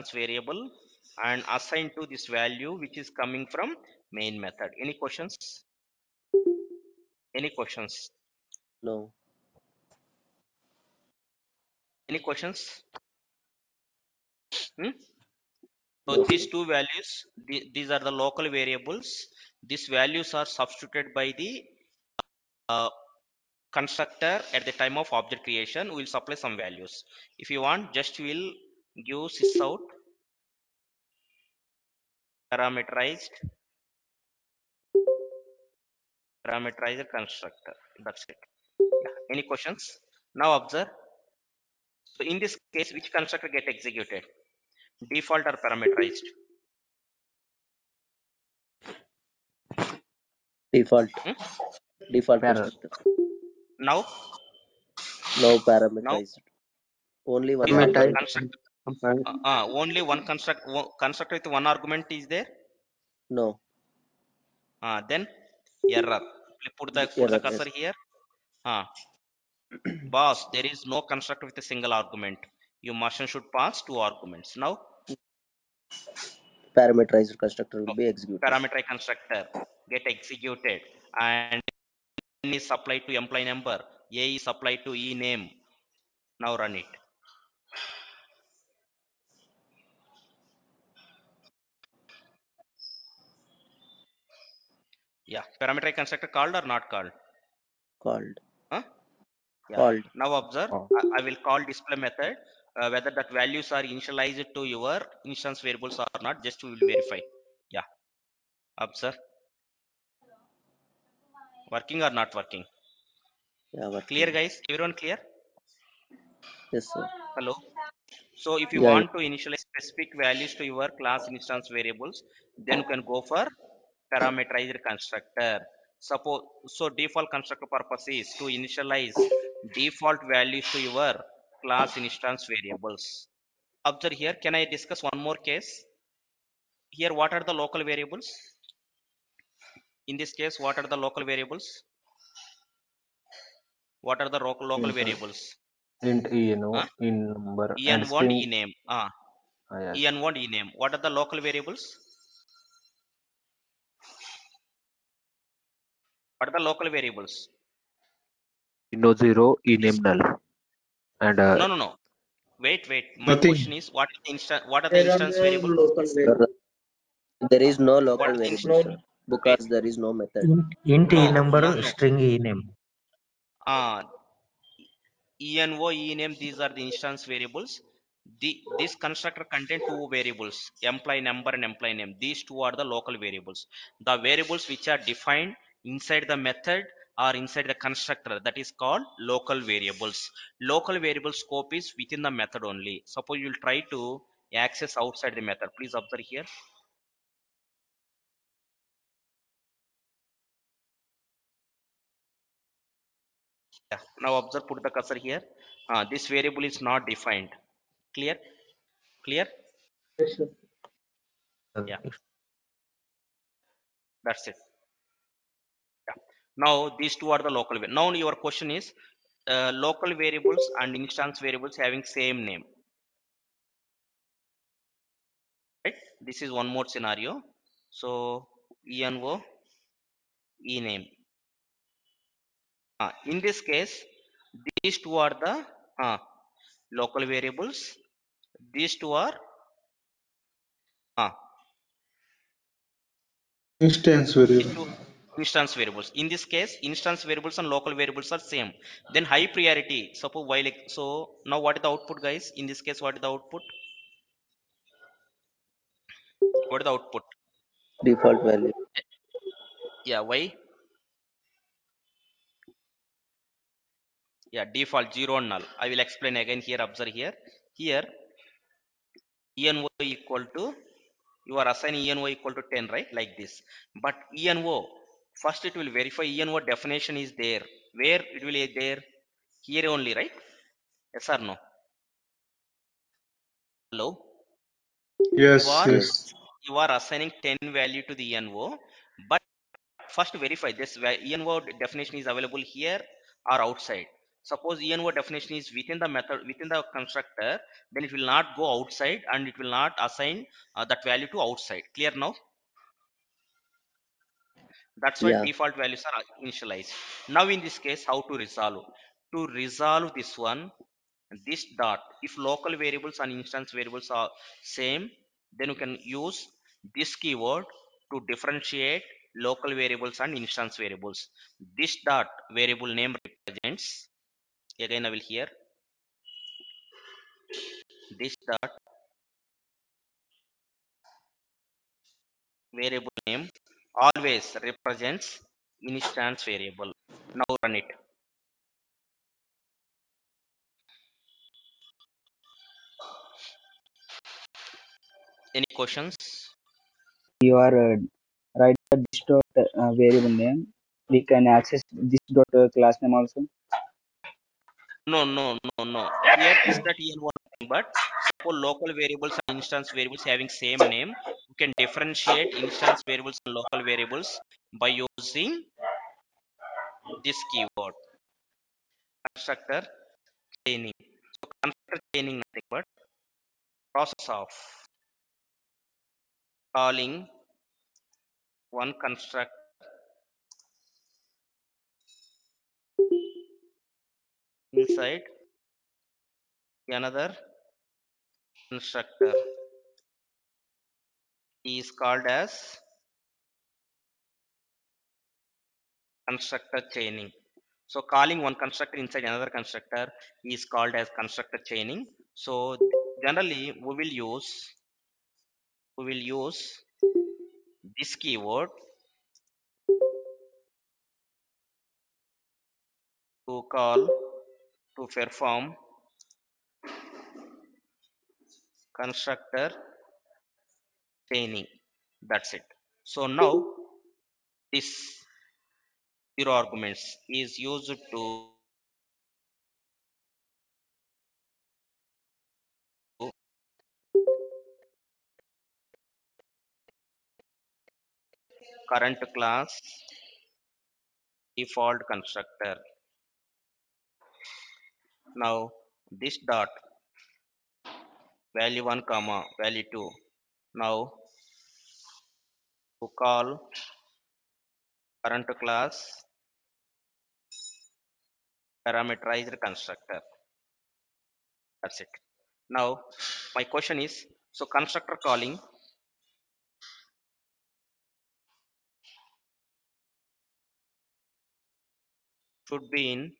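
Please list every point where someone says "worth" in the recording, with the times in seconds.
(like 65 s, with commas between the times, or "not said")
not said.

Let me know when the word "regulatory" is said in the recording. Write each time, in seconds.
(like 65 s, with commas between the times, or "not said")
not said.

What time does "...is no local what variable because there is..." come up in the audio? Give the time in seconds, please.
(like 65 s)
167 s.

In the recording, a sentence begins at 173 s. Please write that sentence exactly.
Ah, envo, name These are the instance variables.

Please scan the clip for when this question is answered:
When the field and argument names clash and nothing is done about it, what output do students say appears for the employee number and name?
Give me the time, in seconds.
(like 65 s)
264 s.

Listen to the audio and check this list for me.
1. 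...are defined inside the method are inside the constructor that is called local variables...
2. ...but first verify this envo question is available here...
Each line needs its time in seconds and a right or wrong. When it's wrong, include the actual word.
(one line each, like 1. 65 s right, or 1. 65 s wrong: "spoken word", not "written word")
1. 184 s right
2. 289 s wrong: "definition", not "question".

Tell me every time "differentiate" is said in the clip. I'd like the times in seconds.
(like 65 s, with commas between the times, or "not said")
318 s, 361 s.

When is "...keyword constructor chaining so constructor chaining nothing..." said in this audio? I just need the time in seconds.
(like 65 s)
367 s.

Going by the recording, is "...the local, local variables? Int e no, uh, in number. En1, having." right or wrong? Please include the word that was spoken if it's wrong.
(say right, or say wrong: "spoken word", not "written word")
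wrong: "string", not "having".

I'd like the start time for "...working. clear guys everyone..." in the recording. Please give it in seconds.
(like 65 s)
113 s.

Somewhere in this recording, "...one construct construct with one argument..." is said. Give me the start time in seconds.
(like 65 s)
60 s.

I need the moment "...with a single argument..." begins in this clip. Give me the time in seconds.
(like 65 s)
71 s.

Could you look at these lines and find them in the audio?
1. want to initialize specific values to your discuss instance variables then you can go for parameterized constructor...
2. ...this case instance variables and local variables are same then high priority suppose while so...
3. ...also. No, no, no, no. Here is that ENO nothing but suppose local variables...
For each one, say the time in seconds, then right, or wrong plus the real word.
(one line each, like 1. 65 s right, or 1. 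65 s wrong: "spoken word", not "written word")
1. 118 s wrong: "class", not "discuss"
2. 246 s right
3. 353 s right.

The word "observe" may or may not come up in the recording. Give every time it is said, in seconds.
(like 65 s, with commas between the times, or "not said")
40 s, 100 s, 133 s, 195 s, 204 s, 266 s.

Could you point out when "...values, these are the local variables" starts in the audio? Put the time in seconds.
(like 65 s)
16 s.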